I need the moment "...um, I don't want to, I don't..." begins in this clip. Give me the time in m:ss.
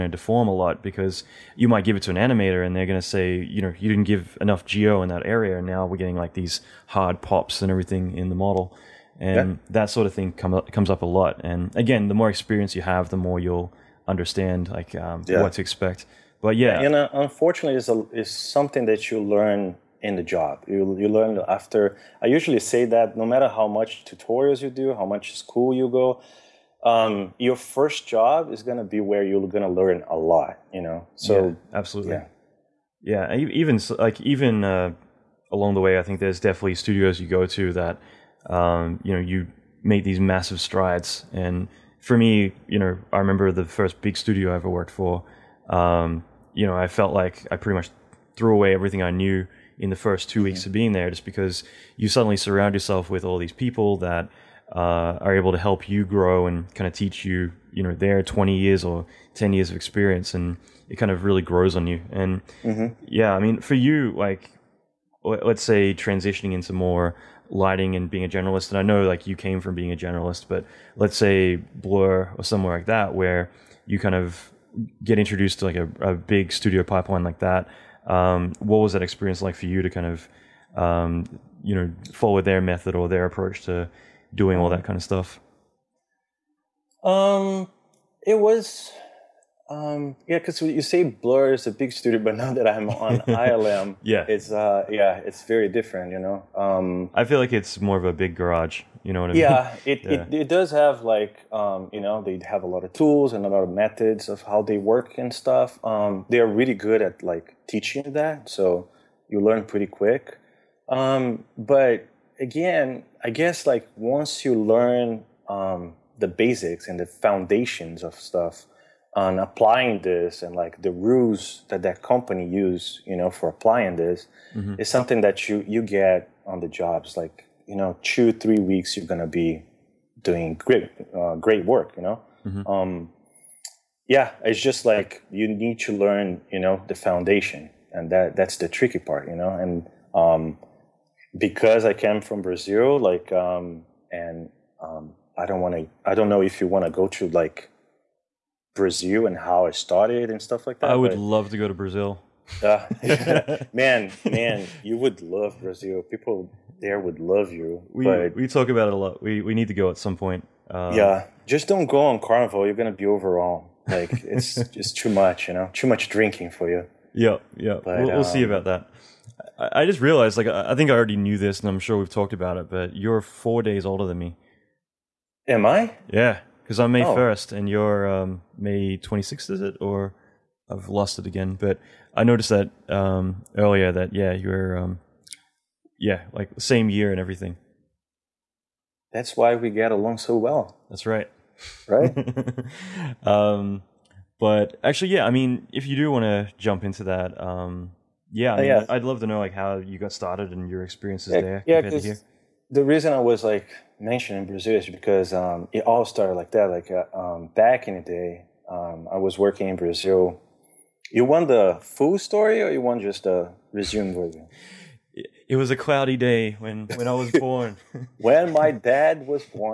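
2:24.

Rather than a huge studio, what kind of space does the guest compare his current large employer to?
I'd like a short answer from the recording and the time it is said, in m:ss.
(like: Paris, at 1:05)
a big garage, at 1:38.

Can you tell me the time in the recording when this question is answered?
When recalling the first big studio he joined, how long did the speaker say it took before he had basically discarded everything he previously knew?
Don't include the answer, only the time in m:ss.
0:49.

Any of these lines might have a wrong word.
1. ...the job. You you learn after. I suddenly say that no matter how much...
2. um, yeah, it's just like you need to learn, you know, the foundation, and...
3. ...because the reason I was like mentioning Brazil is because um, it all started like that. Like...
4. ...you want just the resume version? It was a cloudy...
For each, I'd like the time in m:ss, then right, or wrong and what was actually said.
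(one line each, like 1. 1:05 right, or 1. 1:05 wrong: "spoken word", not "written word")
1. 0:20 wrong: "usually", not "suddenly"
2. 2:12 right
3. 3:21 right
4. 3:32 right.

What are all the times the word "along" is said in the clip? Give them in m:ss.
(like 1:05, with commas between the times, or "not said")
0:35, 3:09.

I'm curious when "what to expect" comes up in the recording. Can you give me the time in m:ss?
0:15.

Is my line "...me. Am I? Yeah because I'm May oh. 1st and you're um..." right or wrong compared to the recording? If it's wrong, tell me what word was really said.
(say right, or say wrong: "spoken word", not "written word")
right.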